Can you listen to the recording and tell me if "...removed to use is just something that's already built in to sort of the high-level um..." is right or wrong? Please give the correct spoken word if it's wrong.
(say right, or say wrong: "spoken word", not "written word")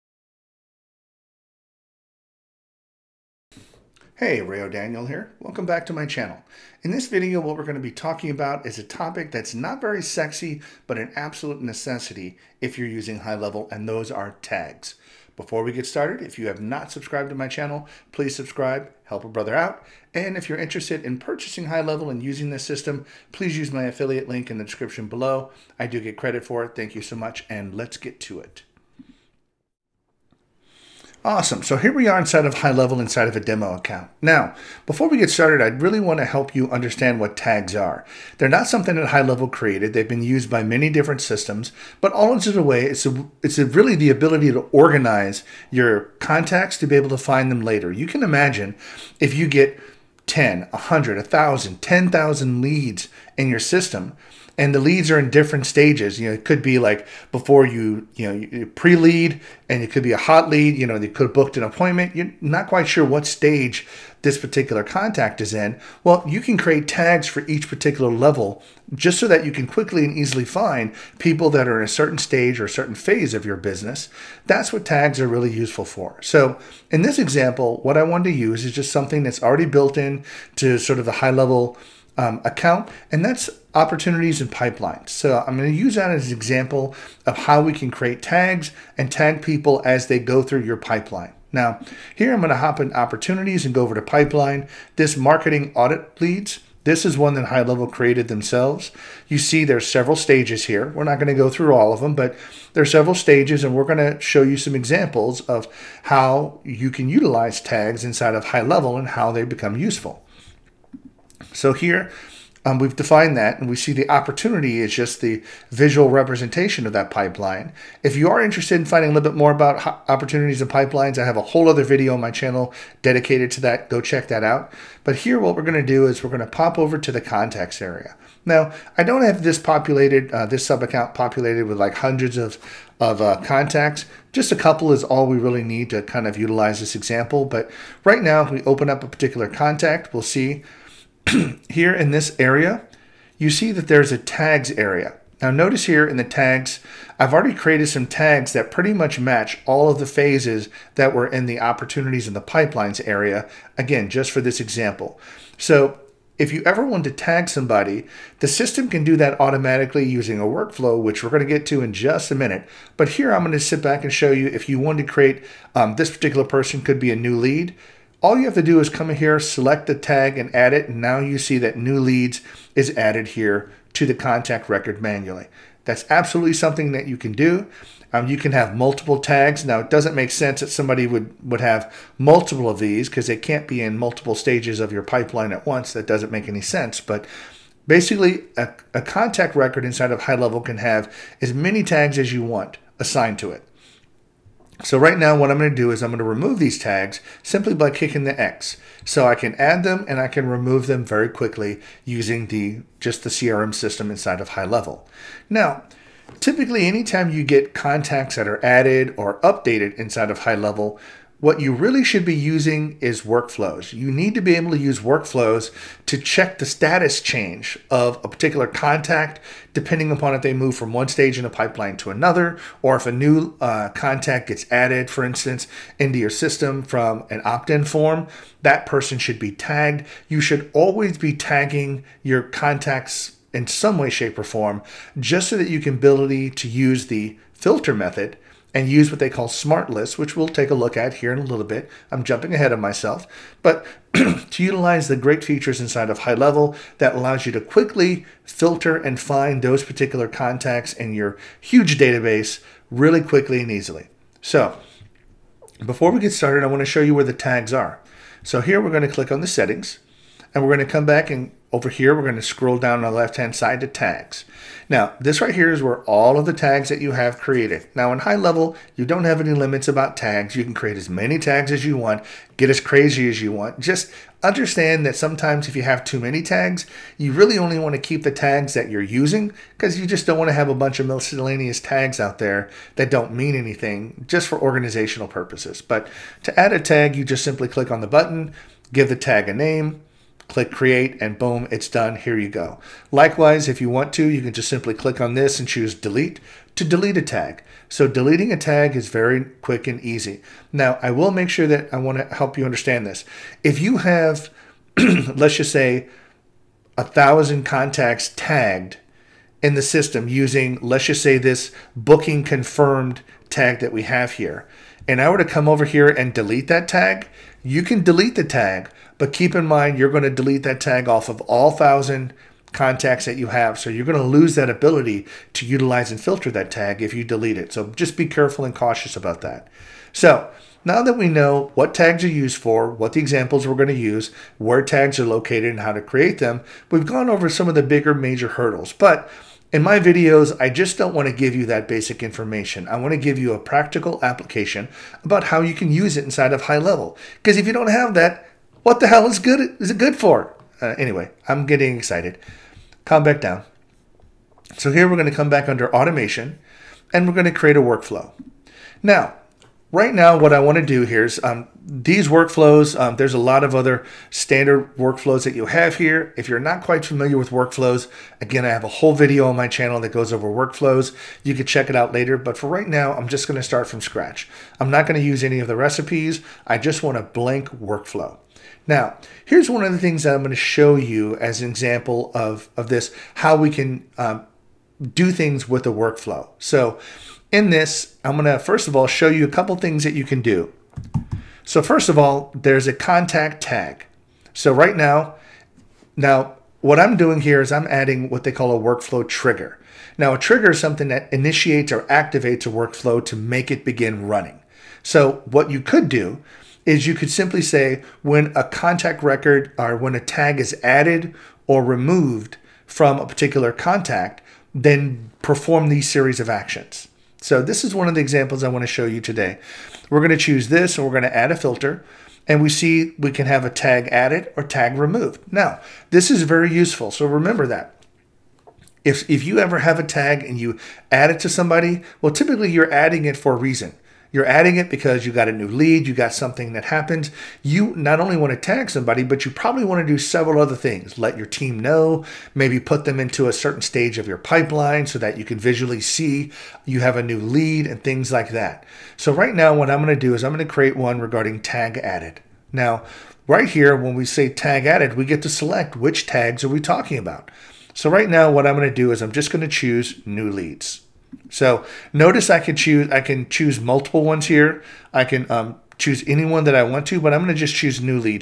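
wrong: "wanted", not "removed".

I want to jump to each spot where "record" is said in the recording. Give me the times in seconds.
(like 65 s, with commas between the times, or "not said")
174 s, 189 s, 409 s.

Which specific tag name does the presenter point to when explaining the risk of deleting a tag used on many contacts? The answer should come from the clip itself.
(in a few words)
Booking confirmed.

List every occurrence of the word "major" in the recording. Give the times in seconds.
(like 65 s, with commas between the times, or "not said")
338 s.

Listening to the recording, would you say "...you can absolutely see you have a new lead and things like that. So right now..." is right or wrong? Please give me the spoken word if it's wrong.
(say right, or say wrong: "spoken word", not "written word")
wrong: "visually", not "absolutely".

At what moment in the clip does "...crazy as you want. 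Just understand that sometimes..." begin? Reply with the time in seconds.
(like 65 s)
272 s.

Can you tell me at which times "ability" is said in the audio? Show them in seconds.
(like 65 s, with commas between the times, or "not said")
44 s, 235 s, 324 s.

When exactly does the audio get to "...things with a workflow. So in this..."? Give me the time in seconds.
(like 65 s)
385 s.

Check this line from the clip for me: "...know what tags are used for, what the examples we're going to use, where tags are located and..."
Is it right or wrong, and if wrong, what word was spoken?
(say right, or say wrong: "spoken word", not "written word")
right.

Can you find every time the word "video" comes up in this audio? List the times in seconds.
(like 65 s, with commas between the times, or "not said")
7 s, 121 s, 339 s, 369 s.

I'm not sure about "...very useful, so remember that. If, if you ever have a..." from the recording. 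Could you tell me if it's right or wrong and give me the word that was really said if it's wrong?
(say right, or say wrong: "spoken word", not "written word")
right.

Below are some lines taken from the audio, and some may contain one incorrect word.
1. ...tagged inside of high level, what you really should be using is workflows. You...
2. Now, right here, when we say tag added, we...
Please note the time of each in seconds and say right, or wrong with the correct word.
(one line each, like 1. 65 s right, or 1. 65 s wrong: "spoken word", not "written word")
1. 209 s wrong: "updated", not "tagged"
2. 452 s right.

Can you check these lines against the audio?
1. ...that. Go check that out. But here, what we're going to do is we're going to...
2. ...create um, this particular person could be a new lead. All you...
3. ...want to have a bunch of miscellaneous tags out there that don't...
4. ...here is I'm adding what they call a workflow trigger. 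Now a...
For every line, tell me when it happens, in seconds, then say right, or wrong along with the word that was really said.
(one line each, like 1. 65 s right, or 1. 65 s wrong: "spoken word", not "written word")
1. 123 s right
2. 165 s right
3. 280 s right
4. 397 s right.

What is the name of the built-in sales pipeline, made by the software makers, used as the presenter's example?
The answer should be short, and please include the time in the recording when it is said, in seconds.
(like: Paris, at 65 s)
Marketing audit leads, at 95 s.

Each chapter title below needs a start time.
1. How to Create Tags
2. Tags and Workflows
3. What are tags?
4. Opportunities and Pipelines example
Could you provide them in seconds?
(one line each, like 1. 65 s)
1. 254 s
2. 365 s
3. 34 s
4. 81 s.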